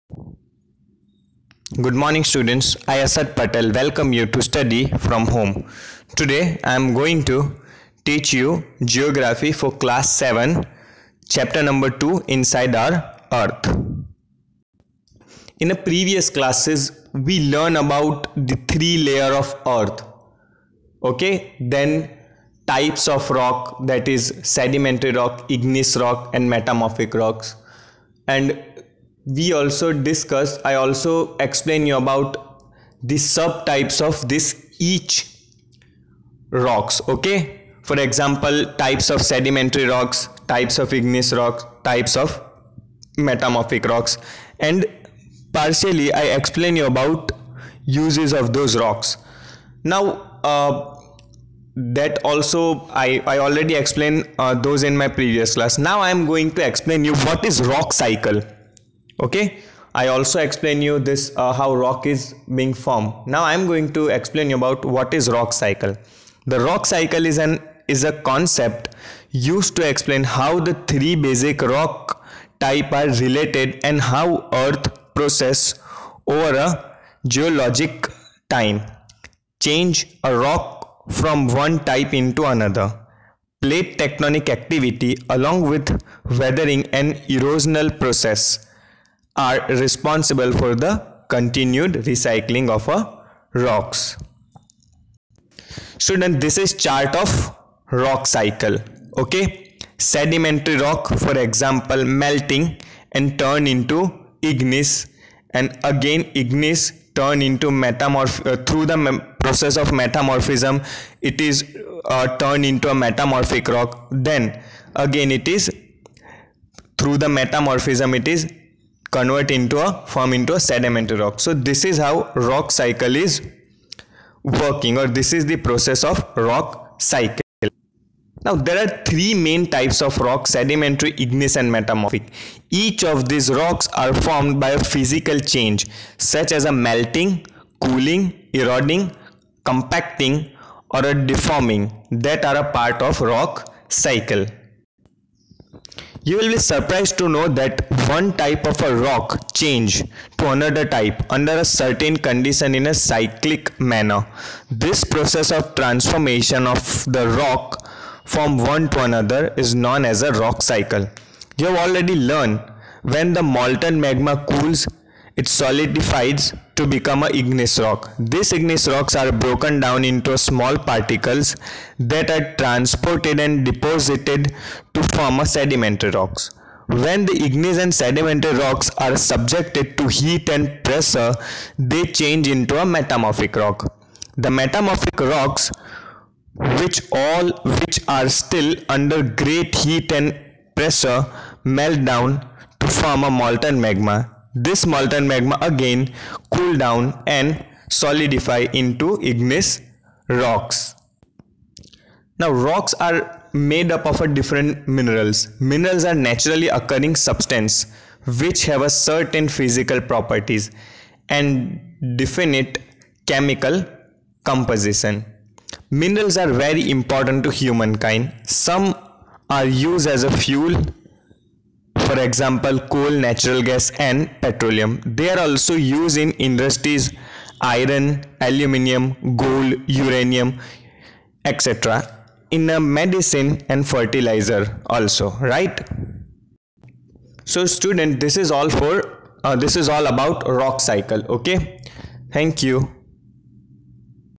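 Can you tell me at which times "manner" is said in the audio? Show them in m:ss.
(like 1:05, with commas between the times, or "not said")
2:33.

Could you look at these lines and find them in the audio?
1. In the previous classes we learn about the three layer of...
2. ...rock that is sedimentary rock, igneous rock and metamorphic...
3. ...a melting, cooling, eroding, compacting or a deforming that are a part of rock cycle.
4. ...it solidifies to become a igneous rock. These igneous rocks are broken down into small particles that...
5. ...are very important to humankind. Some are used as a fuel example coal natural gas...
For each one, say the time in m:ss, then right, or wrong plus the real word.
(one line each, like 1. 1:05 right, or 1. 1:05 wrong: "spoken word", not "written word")
1. 0:15 right
2. 0:23 right
3. 2:16 right
4. 2:45 right
5. 3:36 right.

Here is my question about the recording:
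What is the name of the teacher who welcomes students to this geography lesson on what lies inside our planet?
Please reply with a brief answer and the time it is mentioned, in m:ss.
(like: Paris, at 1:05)
Asad Patel, at 0:03.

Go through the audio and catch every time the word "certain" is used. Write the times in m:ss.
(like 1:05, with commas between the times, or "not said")
2:31, 3:28.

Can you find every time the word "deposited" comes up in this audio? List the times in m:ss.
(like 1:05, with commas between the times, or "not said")
2:53.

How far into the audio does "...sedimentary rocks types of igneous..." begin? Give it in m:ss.
0:39.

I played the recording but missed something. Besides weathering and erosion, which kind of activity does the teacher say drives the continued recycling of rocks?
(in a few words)
plate tectonic activity.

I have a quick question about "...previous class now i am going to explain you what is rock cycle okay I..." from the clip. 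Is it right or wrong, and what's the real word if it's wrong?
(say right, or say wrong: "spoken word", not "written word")
right.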